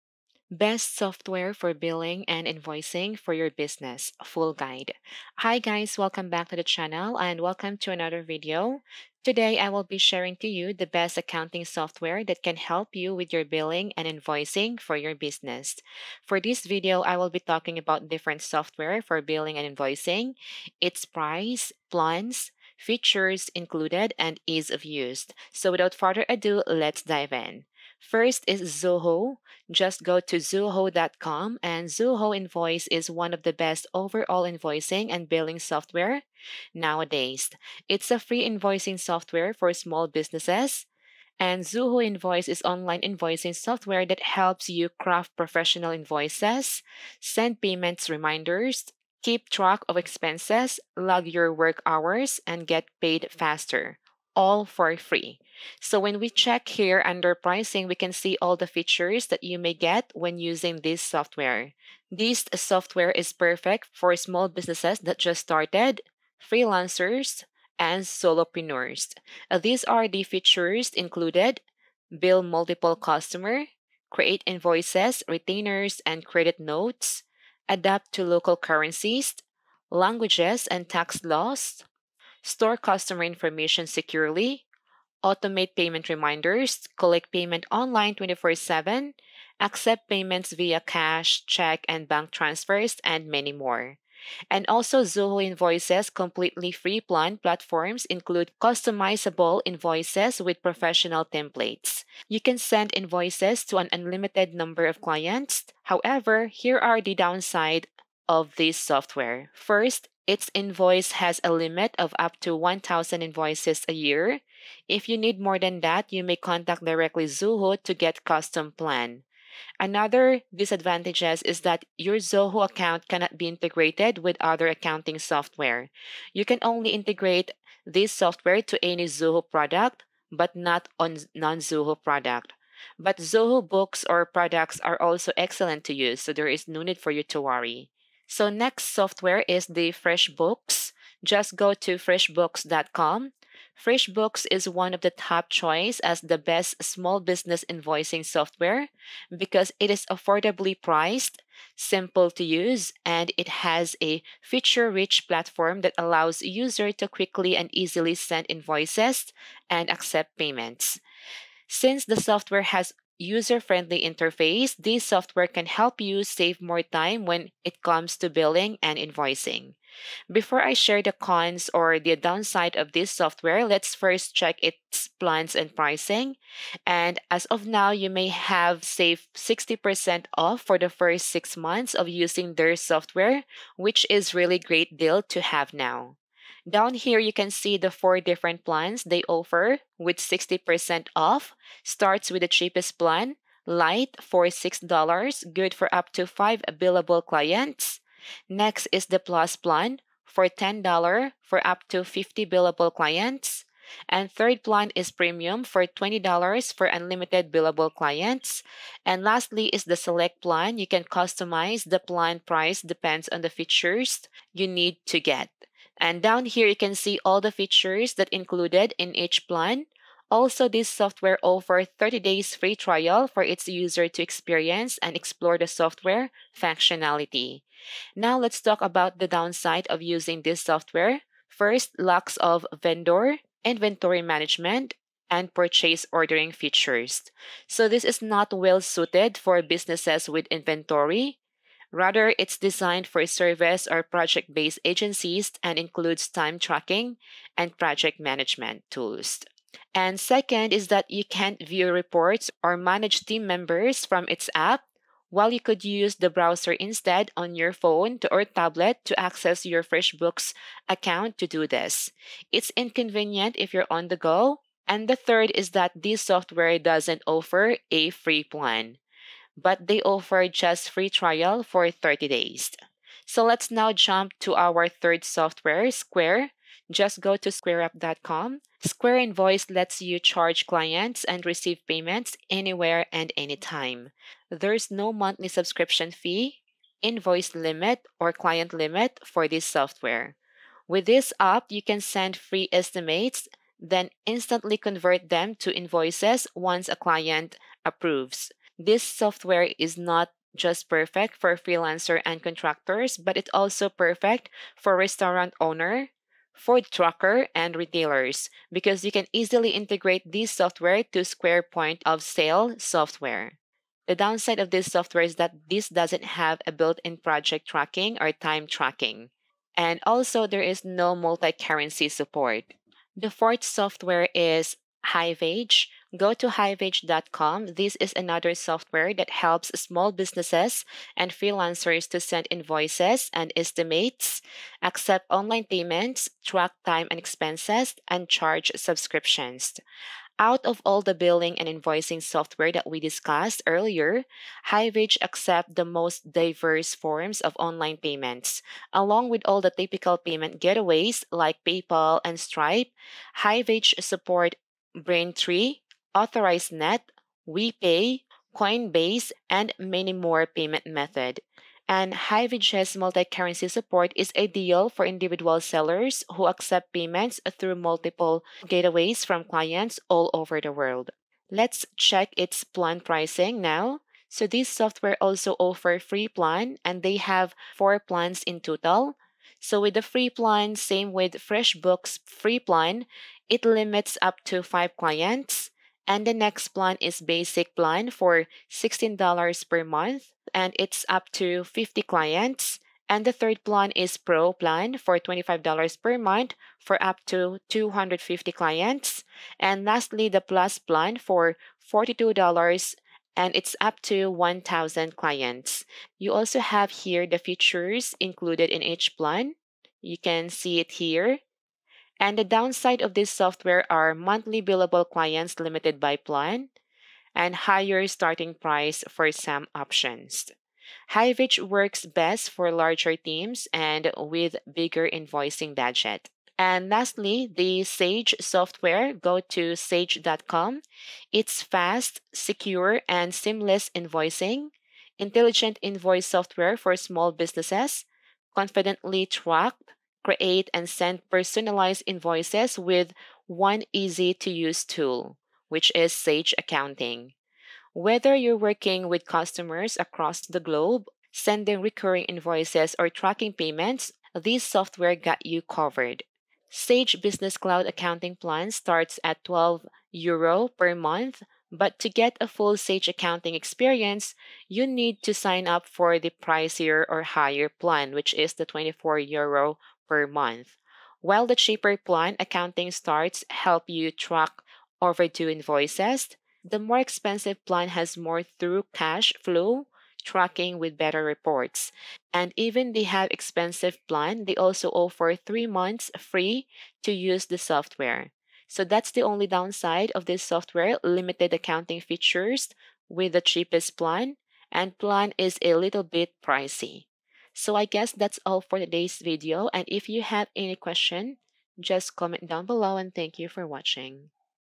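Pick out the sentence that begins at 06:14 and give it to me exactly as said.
So this software also offer free plan and they have four plans in total.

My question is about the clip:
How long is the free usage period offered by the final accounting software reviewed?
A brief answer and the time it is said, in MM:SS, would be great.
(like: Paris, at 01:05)
3 months, at 08:05.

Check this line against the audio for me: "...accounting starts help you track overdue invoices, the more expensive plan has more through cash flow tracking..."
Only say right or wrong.
right.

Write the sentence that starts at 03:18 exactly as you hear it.
Next is the plus plan for $10 for up to 50 billable clients.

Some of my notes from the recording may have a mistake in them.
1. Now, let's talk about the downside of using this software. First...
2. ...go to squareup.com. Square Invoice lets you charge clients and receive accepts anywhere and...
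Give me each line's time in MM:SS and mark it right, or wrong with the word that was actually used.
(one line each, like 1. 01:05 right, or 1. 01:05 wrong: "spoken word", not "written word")
1. 03:48 right
2. 04:37 wrong: "payments", not "accepts".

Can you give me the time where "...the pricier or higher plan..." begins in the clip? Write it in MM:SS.
07:46.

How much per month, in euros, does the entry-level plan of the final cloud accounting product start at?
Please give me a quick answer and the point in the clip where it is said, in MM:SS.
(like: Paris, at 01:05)
12 euro, at 07:39.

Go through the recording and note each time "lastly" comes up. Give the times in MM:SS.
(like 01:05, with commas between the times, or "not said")
03:29, 06:39, 07:06.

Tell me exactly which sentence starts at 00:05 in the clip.
Hi guys, welcome back to the channel and welcome to another video.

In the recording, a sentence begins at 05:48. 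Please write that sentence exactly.
Along with all the typical payment getaways like PayPal and Stripe, Hiveage support Braintree, Authorize.Net, WePay, Coinbase, and many more payment method.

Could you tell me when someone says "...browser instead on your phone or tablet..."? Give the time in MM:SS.
04:16.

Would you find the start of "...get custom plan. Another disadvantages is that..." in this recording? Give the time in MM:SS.
01:57.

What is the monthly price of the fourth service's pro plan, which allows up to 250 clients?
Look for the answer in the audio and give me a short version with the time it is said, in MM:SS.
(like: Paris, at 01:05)
$25, at 06:35.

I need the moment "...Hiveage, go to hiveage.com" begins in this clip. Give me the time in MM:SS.
05:25.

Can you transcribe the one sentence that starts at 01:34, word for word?
And also, Zoho Invoices completely free plan platforms include customizable invoices with professional templates.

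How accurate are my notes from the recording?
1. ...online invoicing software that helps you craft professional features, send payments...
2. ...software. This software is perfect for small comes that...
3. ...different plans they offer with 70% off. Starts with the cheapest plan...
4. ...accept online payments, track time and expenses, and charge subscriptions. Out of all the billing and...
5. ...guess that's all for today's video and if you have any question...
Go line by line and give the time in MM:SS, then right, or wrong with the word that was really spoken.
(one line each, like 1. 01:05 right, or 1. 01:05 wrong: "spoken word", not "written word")
1. 00:42 wrong: "invoices", not "features"
2. 01:01 wrong: "businesses", not "comes"
3. 03:08 wrong: "60", not "70"
4. 05:34 right
5. 08:17 right.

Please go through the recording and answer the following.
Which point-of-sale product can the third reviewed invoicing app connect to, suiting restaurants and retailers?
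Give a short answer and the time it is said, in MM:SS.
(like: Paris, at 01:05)
Square Point of Sale, at 05:11.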